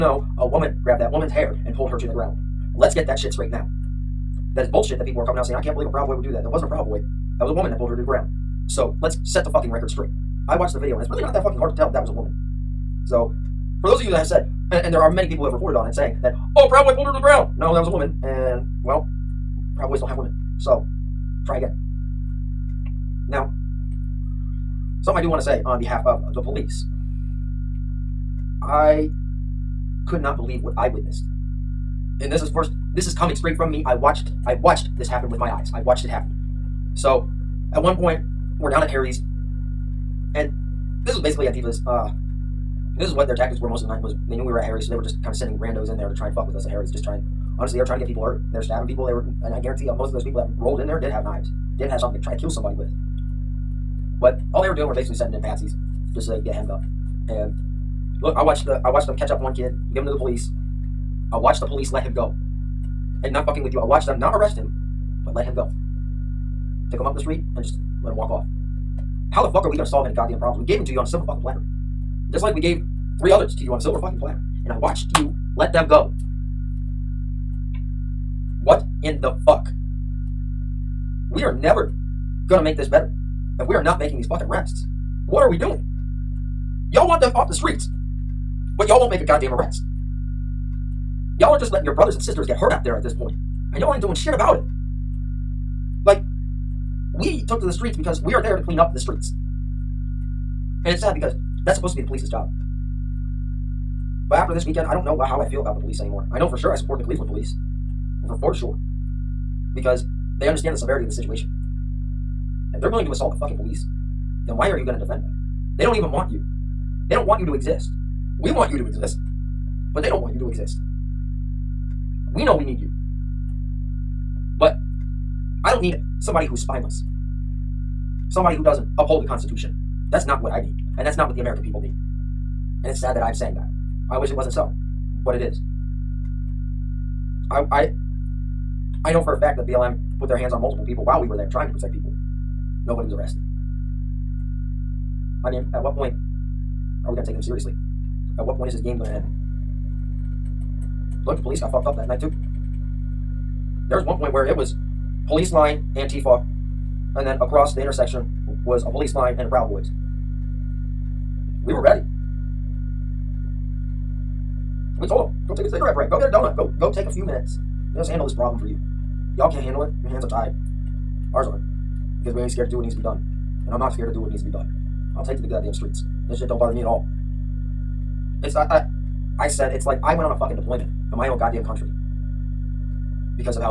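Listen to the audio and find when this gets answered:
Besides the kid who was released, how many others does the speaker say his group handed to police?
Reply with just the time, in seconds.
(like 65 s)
73 s.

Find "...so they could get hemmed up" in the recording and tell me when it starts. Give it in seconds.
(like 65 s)
56 s.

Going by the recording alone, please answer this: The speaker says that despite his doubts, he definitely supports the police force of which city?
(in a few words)
Cleveland.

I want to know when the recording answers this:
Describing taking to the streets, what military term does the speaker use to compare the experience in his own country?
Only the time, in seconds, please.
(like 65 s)
180 s.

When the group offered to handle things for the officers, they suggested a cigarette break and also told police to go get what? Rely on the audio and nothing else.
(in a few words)
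a donut.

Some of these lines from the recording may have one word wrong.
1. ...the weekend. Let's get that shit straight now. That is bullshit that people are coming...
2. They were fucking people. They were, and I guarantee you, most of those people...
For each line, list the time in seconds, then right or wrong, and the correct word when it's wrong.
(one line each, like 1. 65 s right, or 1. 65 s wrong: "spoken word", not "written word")
1. 2 s wrong: "ground", not "weekend"
2. 48 s wrong: "stabbing", not "fucking".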